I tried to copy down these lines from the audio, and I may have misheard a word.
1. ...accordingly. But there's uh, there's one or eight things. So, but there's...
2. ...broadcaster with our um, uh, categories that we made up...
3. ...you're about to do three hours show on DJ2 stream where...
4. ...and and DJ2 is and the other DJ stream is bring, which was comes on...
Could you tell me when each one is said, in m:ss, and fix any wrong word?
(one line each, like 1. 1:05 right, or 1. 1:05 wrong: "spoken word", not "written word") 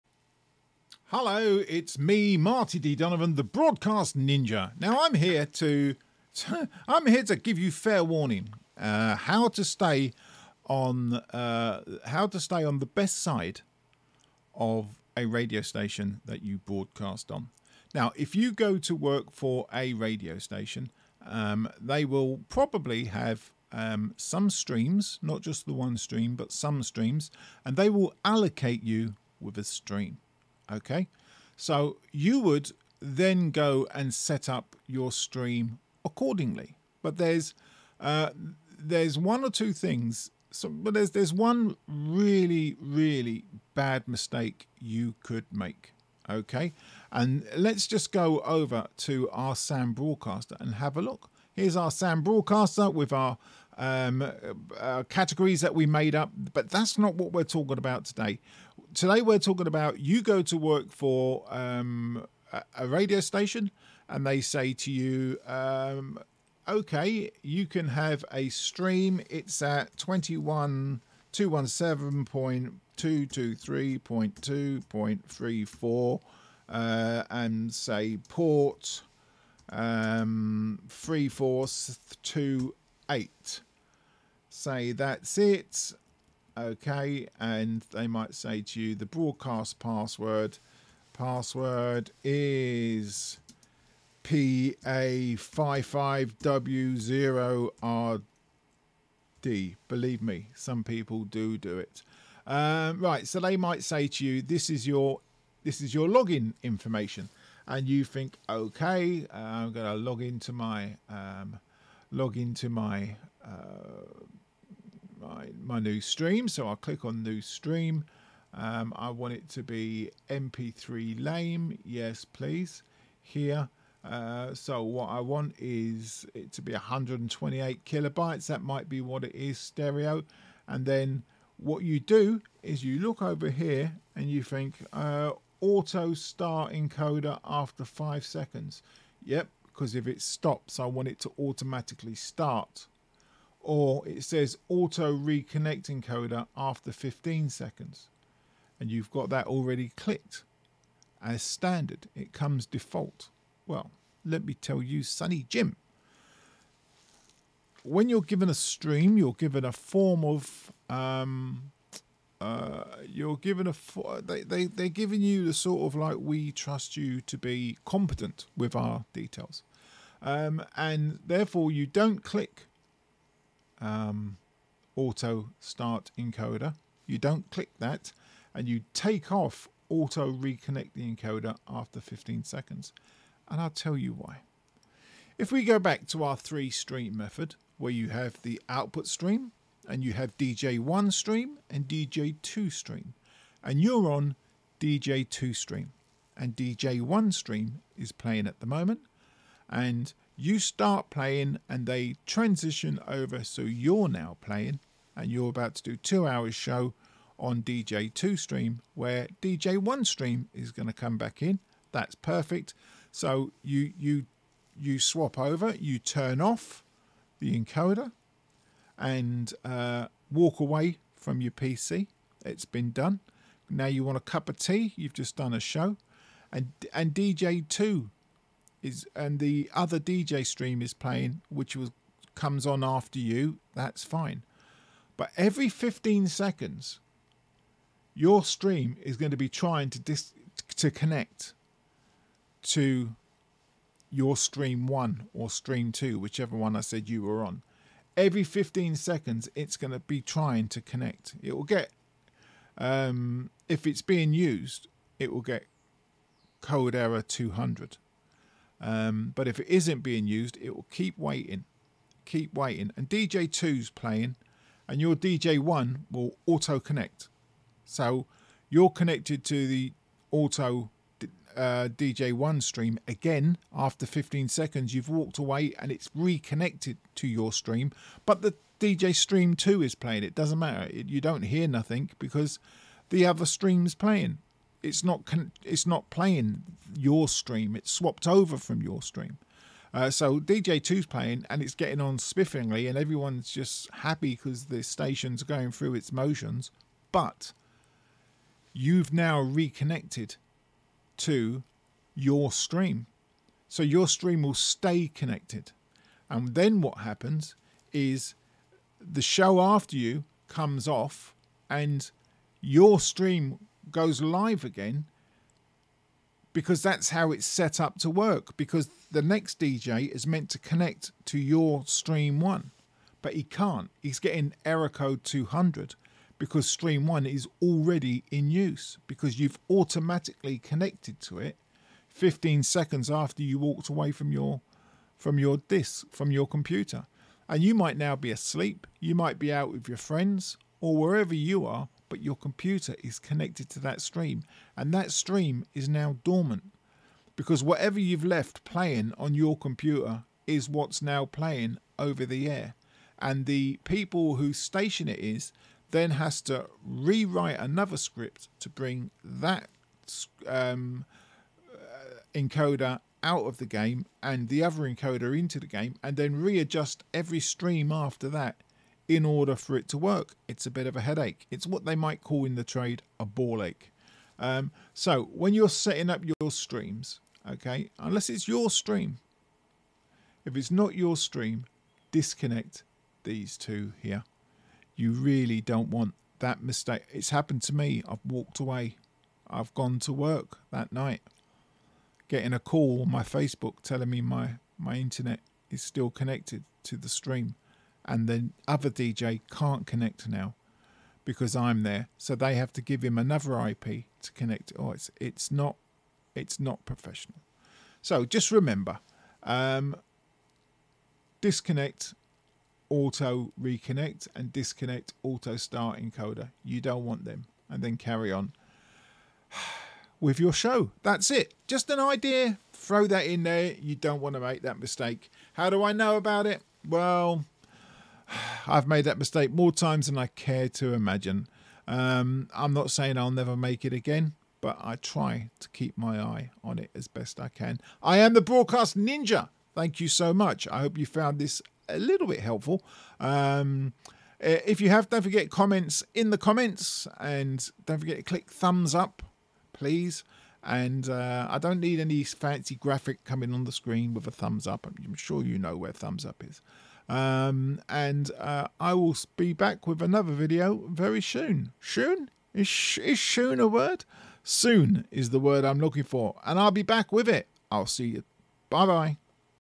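1. 0:36 wrong: "two", not "eight"
2. 0:52 right
3. 3:25 wrong: "two", not "three"
4. 3:46 wrong: "playing", not "bring".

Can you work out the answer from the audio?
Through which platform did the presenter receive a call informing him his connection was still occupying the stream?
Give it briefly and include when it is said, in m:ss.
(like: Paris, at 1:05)
Facebook, at 6:33.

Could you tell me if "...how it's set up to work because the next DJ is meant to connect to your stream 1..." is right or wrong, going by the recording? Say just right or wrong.
right.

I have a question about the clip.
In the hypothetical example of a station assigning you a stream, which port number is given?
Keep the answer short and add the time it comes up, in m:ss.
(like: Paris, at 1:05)
3428, at 1:20.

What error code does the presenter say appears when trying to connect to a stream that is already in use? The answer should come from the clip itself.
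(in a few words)
200.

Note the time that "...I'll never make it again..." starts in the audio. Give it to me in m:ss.
7:13.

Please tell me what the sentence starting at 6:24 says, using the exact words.
You really don't want that mistake.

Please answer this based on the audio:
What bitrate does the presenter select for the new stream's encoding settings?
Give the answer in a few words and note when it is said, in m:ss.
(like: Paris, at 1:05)
128 kilobytes, at 2:06.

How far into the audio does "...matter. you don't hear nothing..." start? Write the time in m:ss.
4:40.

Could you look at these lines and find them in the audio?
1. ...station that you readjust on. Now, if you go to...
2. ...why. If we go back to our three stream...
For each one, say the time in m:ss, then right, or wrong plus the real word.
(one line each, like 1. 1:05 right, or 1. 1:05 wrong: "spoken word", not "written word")
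1. 0:15 wrong: "broadcast", not "readjust"
2. 3:04 right.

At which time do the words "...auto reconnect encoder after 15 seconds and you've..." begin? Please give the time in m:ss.
2:24.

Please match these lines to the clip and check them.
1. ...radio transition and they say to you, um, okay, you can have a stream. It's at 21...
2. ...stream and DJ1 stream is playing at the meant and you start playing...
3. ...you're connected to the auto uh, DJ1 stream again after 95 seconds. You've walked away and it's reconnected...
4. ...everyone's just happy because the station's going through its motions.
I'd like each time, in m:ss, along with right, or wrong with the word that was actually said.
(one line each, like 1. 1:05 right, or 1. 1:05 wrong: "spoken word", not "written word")
1. 1:02 wrong: "station", not "transition"
2. 3:15 wrong: "moment", not "meant"
3. 4:28 wrong: "15", not "95"
4. 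4:52 right.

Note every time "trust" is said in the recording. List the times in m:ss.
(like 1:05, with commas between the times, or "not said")
2:46.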